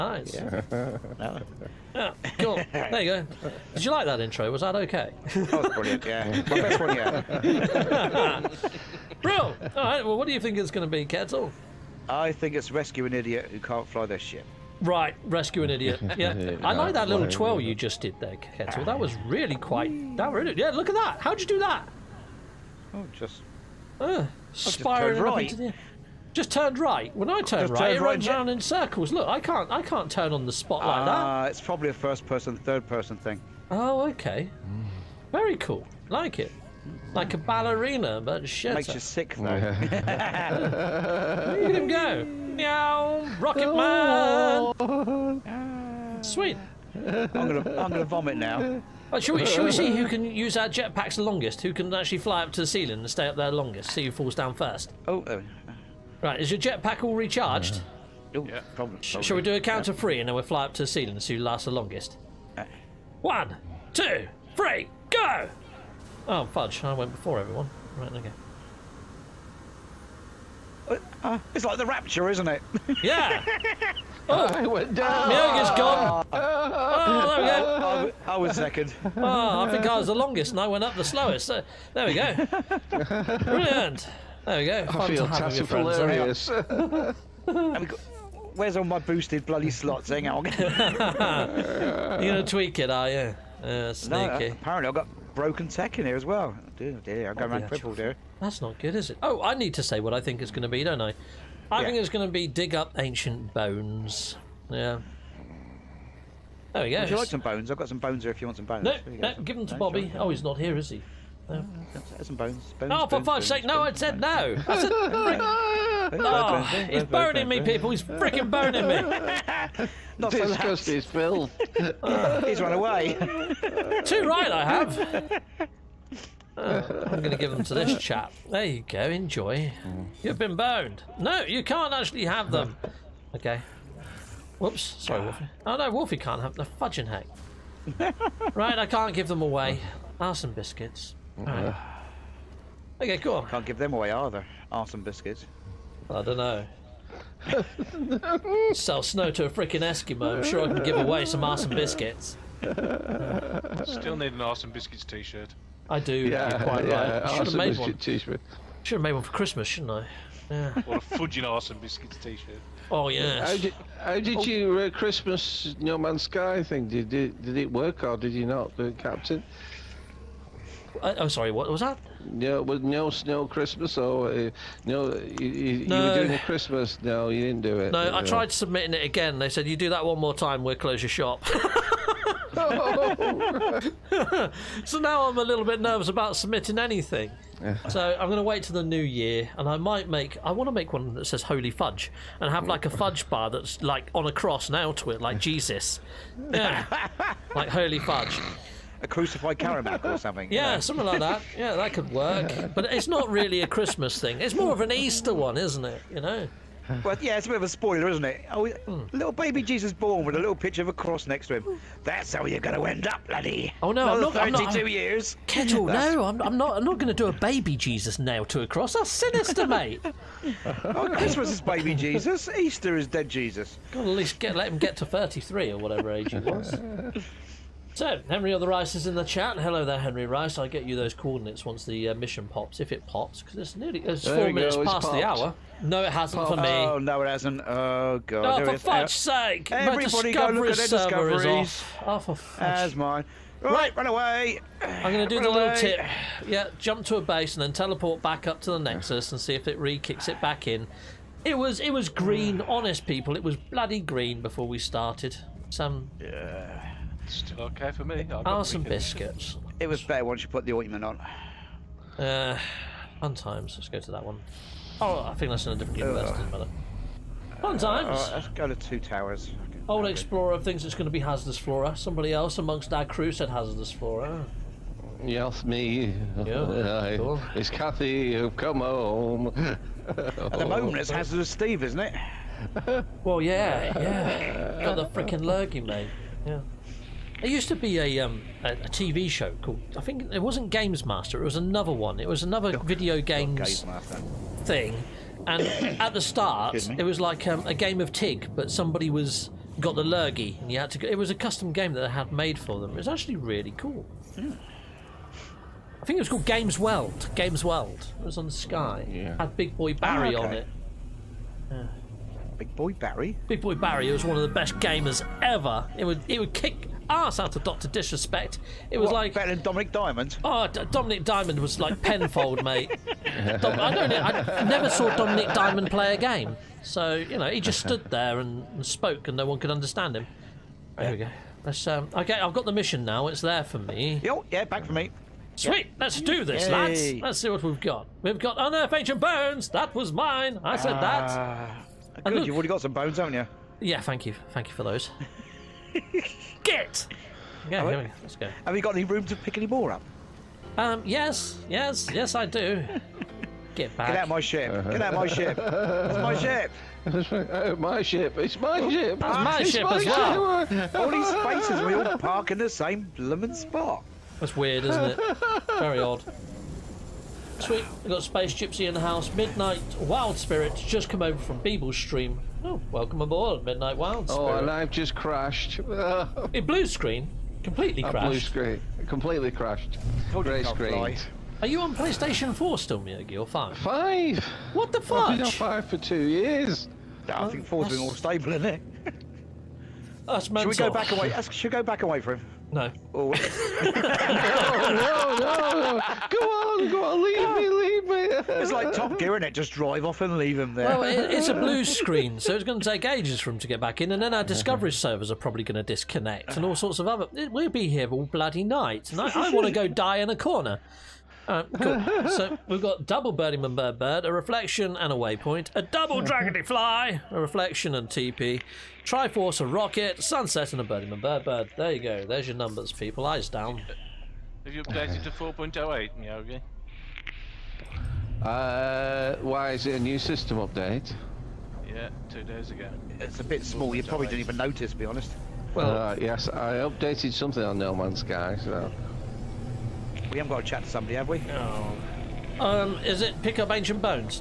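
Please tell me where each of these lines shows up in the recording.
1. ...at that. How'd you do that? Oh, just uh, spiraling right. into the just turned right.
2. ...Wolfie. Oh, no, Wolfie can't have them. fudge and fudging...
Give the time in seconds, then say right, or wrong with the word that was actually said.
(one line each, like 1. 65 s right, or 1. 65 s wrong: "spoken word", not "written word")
1. 20 s right
2. 135 s right.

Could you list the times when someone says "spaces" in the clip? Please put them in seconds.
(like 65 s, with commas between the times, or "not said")
361 s, 368 s.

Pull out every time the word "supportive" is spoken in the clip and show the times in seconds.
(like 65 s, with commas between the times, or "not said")
not said.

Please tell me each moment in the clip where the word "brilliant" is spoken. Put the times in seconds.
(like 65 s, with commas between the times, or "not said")
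5 s, 83 s.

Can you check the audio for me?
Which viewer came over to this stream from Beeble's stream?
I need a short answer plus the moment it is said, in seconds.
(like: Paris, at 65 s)
Midnight Wild Spirits, at 369 s.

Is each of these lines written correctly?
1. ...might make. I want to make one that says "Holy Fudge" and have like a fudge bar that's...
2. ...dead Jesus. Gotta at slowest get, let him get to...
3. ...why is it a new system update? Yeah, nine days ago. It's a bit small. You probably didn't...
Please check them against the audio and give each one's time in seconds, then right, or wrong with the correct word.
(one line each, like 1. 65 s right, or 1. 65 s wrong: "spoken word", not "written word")
1. 189 s right
2. 223 s wrong: "least", not "slowest"
3. 429 s wrong: "two", not "nine".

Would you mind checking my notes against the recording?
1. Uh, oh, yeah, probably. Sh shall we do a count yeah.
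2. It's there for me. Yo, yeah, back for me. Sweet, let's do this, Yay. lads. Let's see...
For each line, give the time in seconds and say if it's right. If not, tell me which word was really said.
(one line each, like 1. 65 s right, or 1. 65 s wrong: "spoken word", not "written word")
1. 58 s right
2. 333 s right.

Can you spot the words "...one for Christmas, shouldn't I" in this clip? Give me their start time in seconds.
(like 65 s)
159 s.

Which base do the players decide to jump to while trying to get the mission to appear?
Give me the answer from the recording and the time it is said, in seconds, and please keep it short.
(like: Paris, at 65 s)
Two Towers, at 268 s.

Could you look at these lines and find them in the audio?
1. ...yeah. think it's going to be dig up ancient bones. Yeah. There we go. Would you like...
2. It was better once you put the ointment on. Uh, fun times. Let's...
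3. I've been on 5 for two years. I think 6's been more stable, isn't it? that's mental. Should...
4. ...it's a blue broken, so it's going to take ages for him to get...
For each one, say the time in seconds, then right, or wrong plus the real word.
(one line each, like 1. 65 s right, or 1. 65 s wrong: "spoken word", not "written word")
1. 101 s right
2. 259 s right
3. 385 s wrong: "4", not "6"
4. 401 s wrong: "screen", not "broken".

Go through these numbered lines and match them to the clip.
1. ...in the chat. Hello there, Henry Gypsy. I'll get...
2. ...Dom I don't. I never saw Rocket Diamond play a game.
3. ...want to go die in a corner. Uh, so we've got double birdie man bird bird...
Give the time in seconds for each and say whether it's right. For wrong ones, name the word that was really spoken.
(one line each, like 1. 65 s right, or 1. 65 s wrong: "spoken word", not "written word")
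1. 229 s wrong: "Rice", not "Gypsy"
2. 323 s wrong: "Dominic", not "Rocket"
3. 409 s right.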